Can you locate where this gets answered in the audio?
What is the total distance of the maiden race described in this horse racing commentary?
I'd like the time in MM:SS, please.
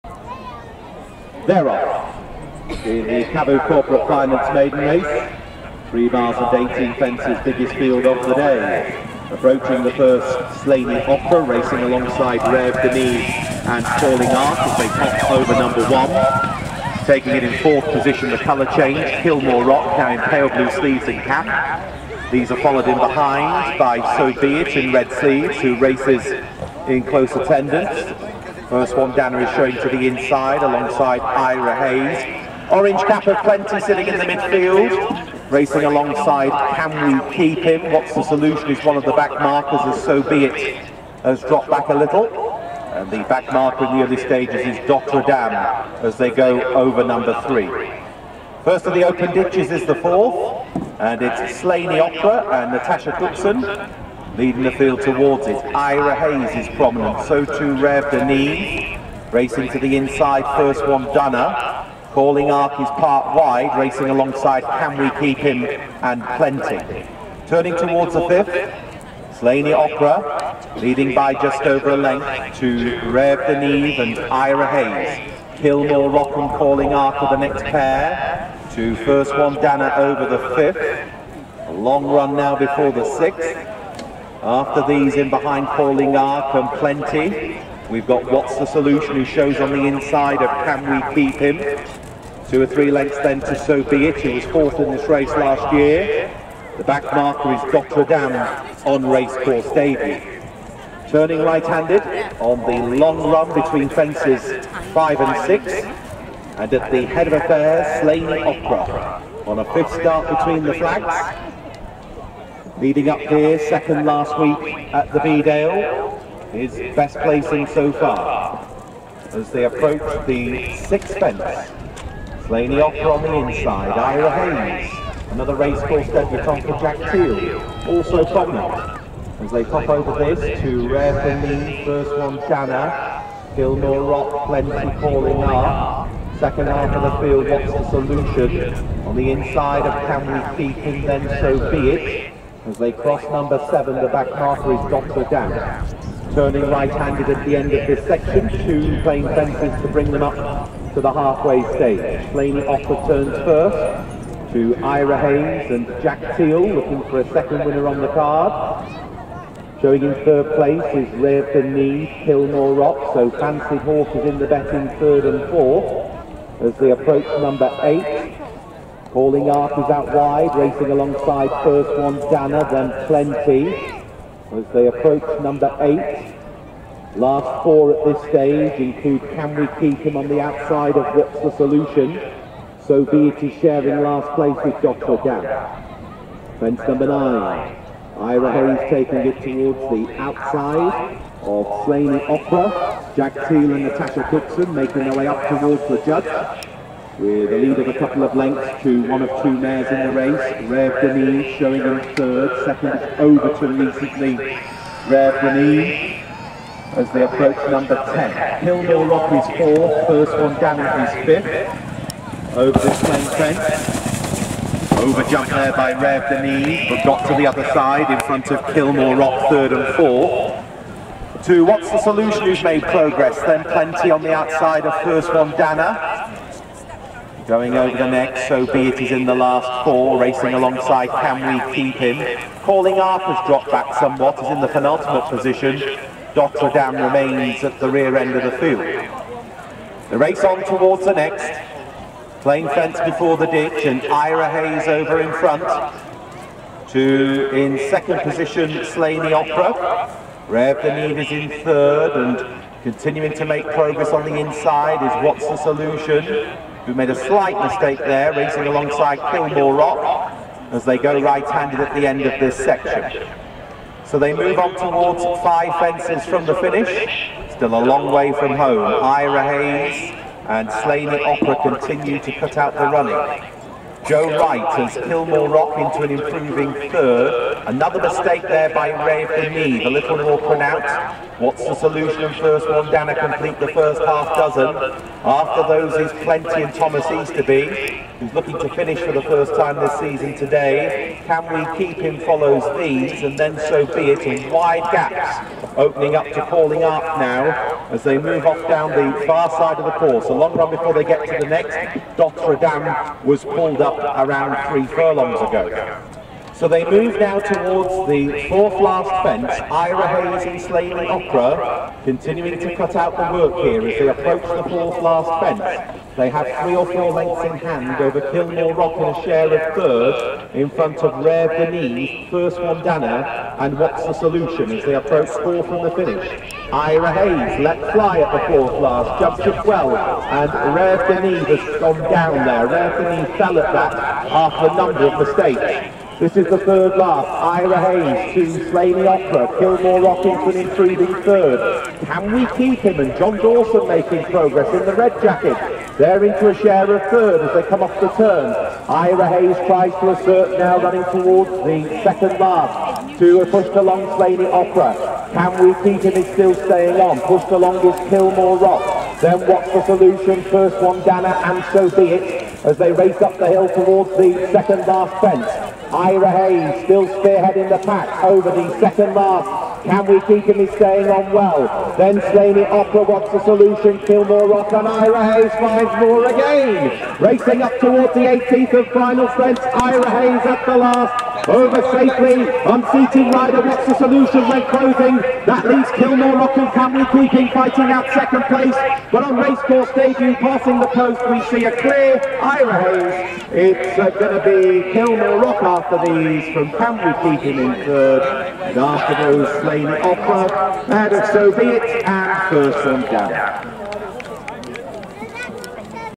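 00:05.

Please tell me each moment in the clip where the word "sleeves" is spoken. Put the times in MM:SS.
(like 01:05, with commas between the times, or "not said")
00:20, 00:25.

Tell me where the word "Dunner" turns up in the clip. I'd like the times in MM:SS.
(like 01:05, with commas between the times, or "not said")
01:01.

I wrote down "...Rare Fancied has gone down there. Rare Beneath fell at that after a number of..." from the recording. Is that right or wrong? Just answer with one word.
wrong.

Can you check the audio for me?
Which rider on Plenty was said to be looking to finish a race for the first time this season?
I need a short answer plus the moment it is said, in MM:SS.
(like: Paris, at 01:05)
Thomas Easterby, at 04:46.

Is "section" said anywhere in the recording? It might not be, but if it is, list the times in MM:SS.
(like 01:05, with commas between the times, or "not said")
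02:28, 04:22.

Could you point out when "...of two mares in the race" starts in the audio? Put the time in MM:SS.
03:19.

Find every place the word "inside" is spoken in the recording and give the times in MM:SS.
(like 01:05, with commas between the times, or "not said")
00:30, 00:59, 01:29, 02:03, 02:19, 04:14.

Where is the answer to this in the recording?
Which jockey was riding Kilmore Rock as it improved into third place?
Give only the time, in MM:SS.
04:34.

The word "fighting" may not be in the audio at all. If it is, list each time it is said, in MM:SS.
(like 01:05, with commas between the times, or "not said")
06:27.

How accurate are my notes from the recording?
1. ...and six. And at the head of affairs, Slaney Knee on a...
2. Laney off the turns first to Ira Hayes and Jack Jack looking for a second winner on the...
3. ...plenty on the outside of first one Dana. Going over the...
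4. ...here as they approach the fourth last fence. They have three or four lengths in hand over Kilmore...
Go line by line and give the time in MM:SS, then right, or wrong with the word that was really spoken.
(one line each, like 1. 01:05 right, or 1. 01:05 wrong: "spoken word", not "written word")
1. 01:45 wrong: "Opera", not "Knee"
2. 02:32 wrong: "Teal", not "Jack"
3. 03:43 right
4. 05:13 right.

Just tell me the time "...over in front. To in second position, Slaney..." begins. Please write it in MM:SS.
04:04.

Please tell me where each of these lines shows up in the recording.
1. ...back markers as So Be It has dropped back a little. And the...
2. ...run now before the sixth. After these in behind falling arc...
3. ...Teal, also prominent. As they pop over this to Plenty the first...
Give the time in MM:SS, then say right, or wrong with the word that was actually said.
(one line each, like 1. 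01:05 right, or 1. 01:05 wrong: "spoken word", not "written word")
1. 00:39 right
2. 01:22 right
3. 02:07 wrong: "Rare", not "Plenty".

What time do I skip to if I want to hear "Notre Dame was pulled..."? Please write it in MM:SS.
05:02.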